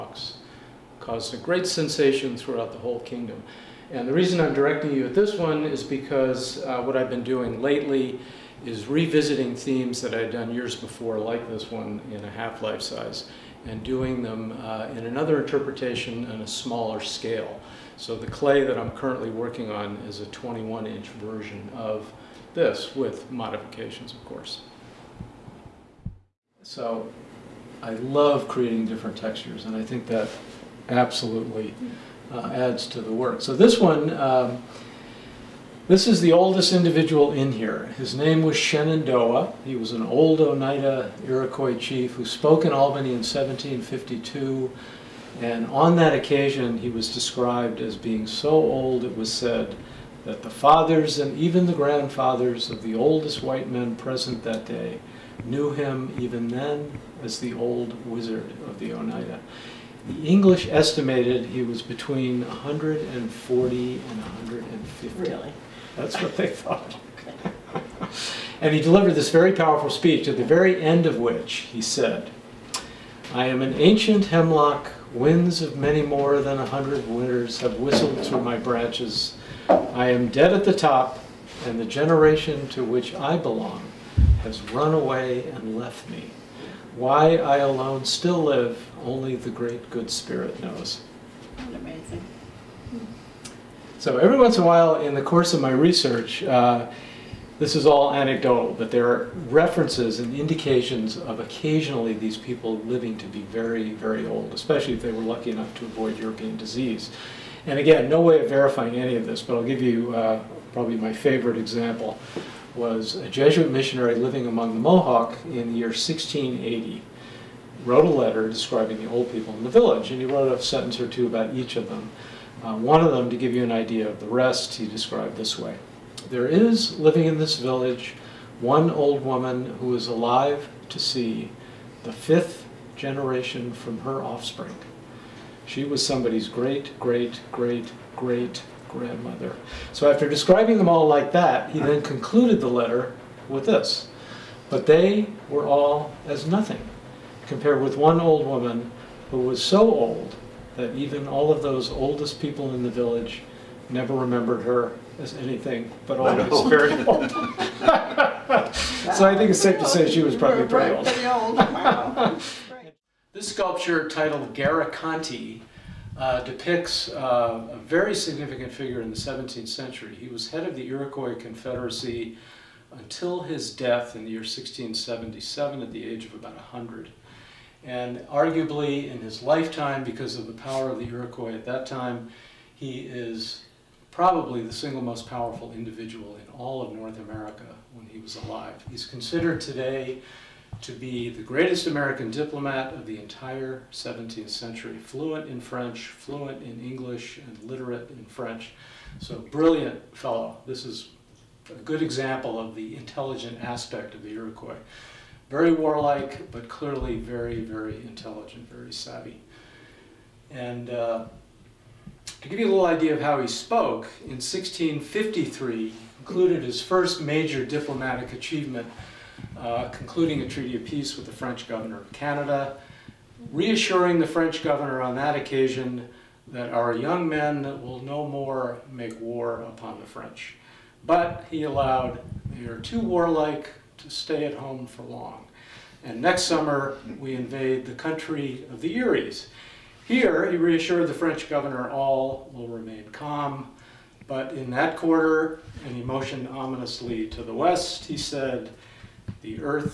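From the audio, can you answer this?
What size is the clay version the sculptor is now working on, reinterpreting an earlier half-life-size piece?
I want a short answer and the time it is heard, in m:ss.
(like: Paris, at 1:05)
21 inch, at 0:20.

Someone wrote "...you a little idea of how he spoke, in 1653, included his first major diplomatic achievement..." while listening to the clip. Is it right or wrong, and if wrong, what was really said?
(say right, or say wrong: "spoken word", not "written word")
right.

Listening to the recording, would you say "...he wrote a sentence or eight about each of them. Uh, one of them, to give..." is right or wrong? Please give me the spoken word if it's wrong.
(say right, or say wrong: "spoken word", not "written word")
wrong: "two", not "eight".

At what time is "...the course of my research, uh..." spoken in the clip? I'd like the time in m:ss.
1:35.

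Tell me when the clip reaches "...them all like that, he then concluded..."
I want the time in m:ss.
2:20.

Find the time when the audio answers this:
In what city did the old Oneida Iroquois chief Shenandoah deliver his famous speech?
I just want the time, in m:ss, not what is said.
0:42.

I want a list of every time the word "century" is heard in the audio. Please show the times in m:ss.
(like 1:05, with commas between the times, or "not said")
2:49, 3:14.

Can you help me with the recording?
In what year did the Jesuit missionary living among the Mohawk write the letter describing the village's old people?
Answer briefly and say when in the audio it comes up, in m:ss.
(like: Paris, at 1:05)
1680, at 1:55.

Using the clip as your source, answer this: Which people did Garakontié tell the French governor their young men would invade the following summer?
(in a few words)
the Eries.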